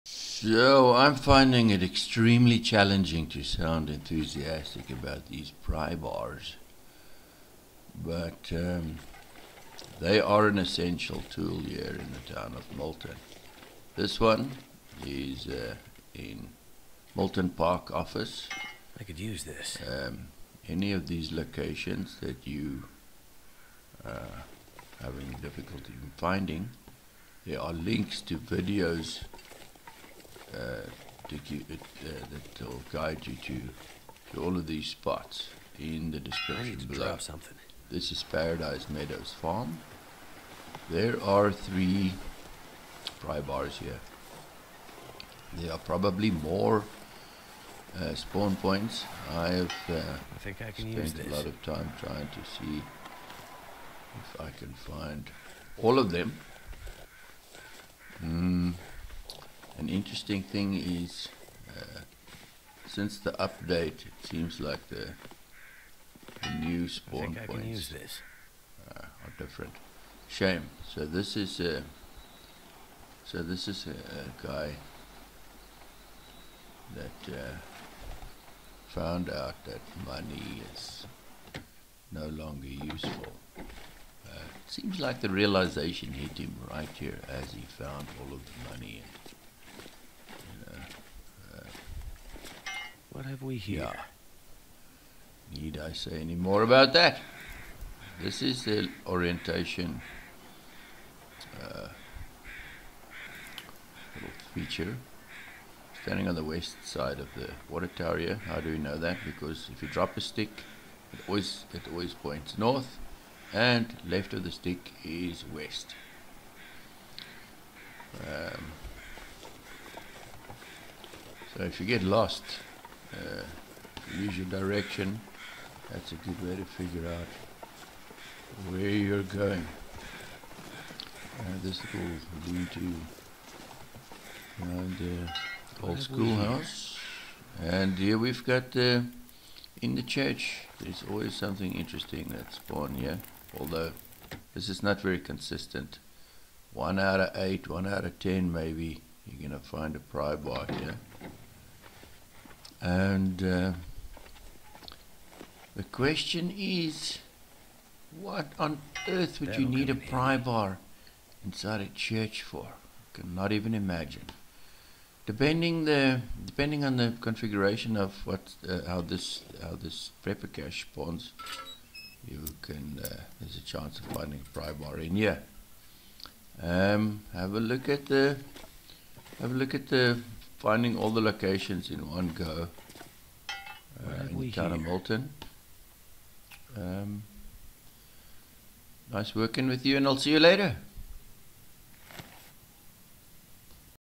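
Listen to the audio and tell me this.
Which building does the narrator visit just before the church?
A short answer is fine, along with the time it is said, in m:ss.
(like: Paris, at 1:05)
Old schoolhouse, at 2:15.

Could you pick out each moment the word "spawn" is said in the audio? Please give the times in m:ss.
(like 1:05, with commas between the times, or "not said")
0:48, 1:06, 2:50.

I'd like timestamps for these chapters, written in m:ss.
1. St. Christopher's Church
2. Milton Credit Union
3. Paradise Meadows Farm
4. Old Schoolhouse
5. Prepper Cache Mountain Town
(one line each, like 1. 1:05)
1. 2:19
2. 1:10
3. 0:23
4. 1:38
5. 2:43.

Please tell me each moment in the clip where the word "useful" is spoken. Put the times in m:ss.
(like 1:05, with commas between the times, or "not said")
1:22.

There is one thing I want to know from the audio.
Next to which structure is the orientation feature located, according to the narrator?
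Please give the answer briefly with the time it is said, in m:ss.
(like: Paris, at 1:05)
The water tower, at 1:47.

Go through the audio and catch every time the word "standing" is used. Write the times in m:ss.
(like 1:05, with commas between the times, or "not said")
1:46.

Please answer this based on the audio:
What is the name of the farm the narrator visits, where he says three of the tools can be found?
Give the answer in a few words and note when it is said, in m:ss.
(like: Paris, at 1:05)
Paradise Meadows Farm, at 0:38.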